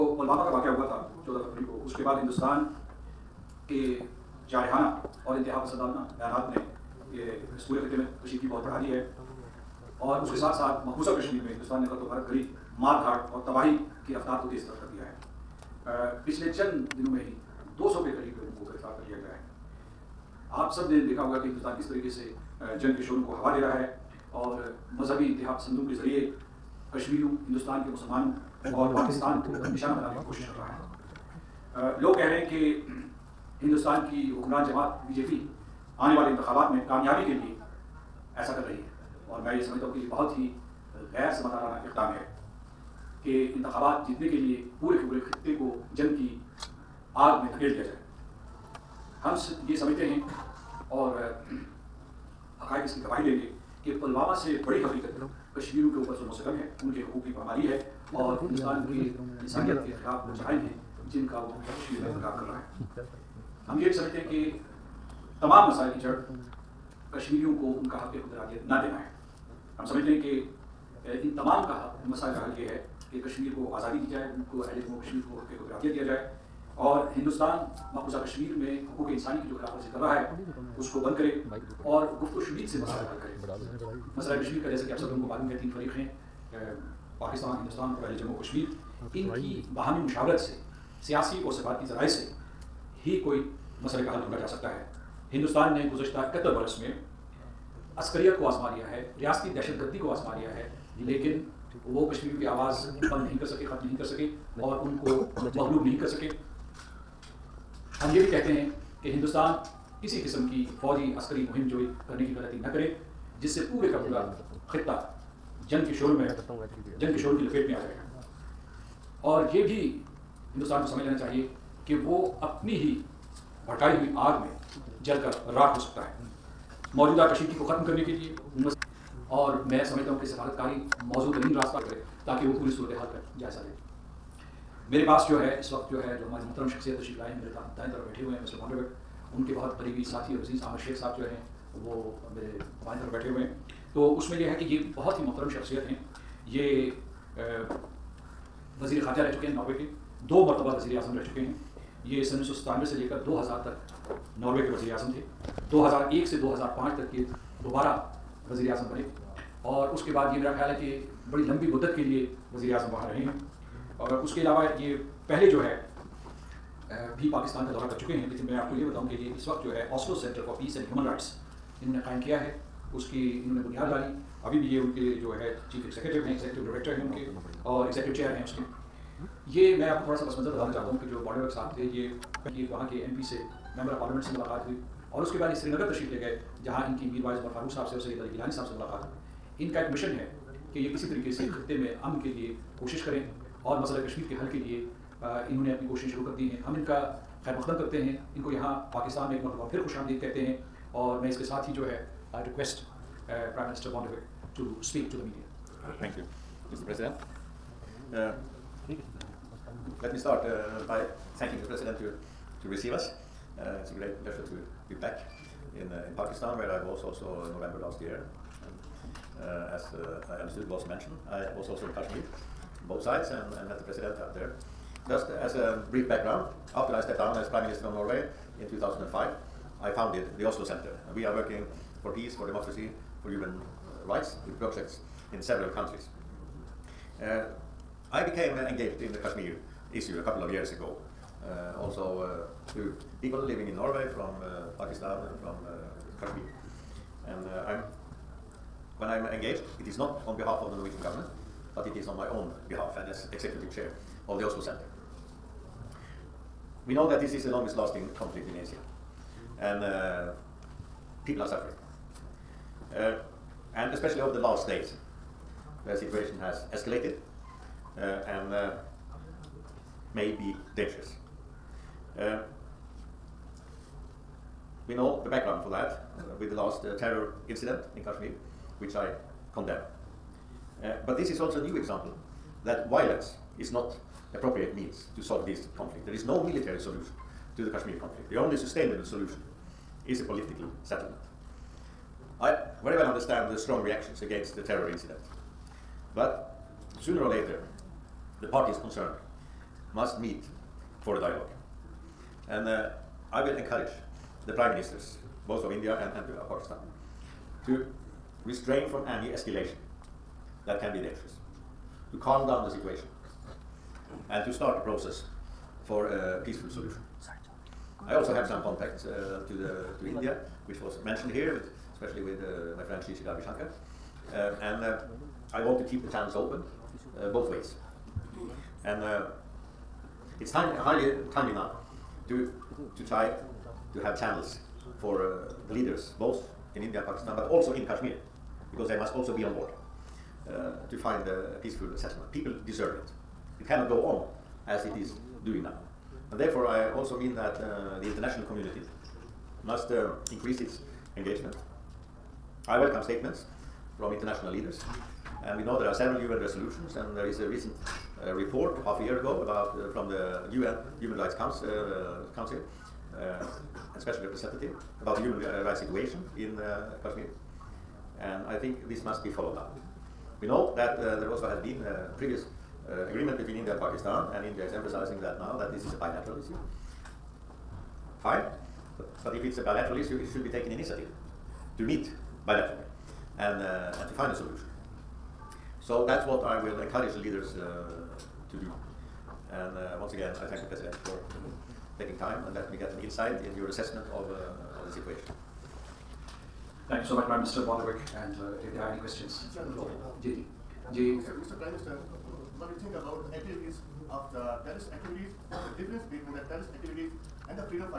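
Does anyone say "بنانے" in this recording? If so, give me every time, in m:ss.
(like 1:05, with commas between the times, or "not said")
0:29.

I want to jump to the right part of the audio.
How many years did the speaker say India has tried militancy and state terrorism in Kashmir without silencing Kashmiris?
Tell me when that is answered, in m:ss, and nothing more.
1:36.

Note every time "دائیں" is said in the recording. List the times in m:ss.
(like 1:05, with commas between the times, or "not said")
2:17.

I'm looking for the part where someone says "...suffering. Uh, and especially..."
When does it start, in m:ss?
4:21.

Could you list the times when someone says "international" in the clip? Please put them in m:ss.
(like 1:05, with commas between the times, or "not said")
5:48, 5:54.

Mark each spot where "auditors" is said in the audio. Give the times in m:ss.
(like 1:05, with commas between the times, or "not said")
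not said.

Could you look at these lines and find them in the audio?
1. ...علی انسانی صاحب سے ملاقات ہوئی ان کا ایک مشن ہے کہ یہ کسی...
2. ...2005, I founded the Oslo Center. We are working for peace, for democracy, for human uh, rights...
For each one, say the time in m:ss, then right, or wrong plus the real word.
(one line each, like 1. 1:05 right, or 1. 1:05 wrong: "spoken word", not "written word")
1. 3:08 wrong: "گیلانی", not "انسانی"
2. 3:48 right.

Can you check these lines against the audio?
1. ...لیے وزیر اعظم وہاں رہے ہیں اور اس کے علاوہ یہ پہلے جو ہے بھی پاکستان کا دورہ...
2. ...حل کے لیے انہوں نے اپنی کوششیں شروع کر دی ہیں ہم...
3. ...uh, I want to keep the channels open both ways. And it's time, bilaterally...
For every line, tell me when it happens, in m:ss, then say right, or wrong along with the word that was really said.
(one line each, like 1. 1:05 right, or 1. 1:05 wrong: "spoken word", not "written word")
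1. 2:42 right
2. 3:14 right
3. 5:24 wrong: "highly", not "bilaterally".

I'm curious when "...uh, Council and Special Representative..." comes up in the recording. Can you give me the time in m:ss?
6:01.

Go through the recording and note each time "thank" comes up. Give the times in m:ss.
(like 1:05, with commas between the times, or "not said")
6:30, 6:36.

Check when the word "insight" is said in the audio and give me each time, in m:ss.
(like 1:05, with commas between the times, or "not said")
6:33.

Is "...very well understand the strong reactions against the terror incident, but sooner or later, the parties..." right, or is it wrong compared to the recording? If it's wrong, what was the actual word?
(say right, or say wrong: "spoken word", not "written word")
right.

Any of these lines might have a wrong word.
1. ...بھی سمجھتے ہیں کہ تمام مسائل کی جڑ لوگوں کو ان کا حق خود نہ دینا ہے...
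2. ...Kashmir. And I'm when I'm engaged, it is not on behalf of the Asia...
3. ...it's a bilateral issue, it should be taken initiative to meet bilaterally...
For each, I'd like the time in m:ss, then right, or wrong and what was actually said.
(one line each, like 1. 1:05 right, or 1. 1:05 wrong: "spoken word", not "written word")
1. 1:03 wrong: "کشمیریوں", not "لوگوں"
2. 4:06 wrong: "Norwegian", not "Asia"
3. 6:19 right.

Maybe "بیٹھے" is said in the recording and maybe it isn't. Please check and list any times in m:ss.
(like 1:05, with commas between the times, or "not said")
2:18, 2:23.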